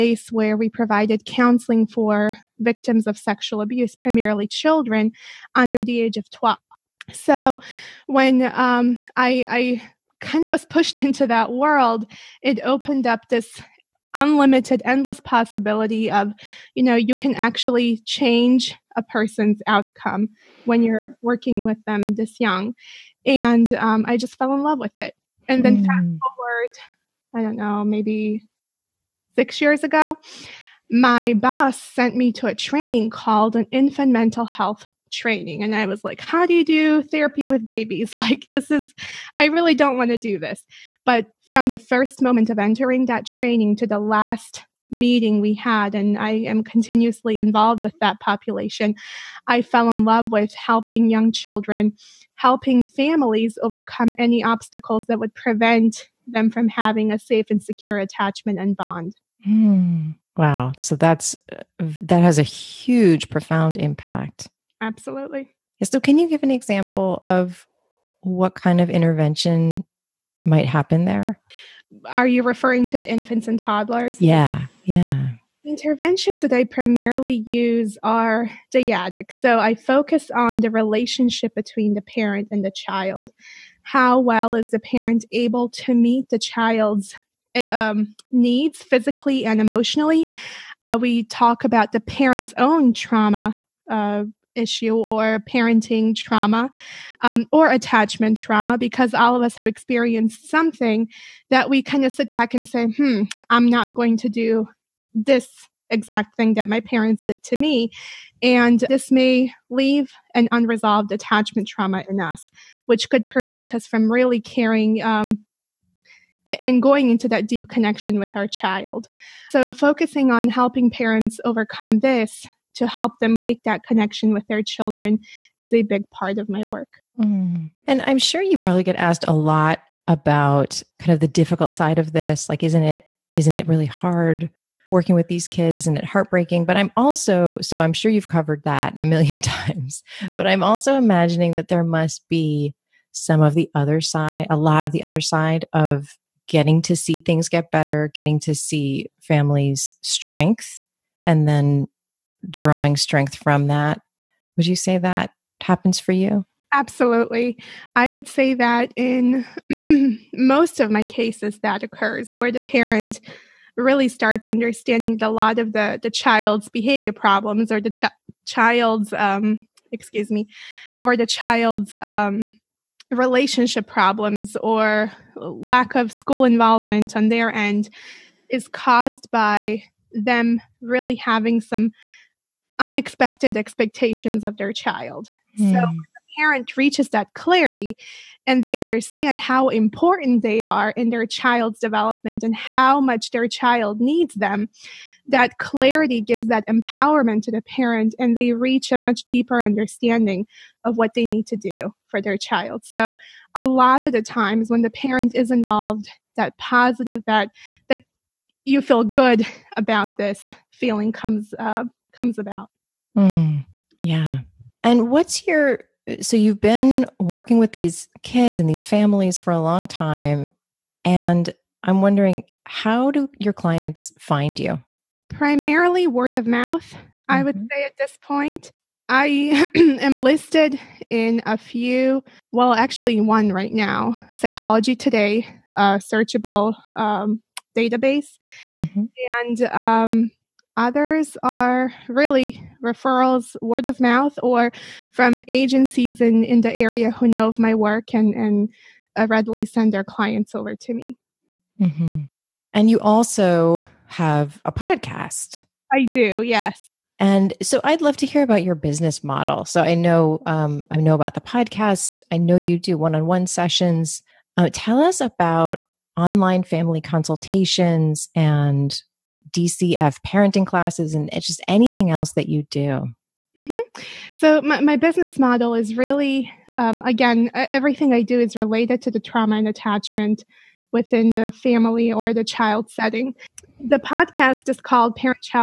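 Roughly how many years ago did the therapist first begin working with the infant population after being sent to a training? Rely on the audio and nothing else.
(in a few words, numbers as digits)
6 years.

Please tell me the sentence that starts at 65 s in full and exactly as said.
So, can you give an example of what kind of intervention might happen there?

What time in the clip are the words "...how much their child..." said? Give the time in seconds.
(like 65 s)
192 s.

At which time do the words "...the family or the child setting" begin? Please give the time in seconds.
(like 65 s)
281 s.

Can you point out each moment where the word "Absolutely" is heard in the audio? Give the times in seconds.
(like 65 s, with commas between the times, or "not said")
64 s, 156 s.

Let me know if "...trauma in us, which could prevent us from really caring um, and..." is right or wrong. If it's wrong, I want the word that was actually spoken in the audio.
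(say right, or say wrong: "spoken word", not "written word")
right.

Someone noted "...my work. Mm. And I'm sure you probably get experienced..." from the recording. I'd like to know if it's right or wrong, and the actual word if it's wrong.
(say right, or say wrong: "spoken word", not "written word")
wrong: "asked", not "experienced".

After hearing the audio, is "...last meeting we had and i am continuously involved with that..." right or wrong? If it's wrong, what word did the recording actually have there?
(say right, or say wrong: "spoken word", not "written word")
right.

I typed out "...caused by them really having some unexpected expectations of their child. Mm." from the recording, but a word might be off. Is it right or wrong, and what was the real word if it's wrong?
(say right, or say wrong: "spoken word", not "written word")
right.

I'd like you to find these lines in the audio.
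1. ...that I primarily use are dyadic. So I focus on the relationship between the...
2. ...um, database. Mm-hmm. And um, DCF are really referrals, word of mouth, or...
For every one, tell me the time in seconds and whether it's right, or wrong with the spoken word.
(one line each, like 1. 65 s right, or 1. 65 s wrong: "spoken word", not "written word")
1. 76 s right
2. 236 s wrong: "Others", not "DCF".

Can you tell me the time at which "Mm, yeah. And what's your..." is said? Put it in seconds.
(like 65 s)
213 s.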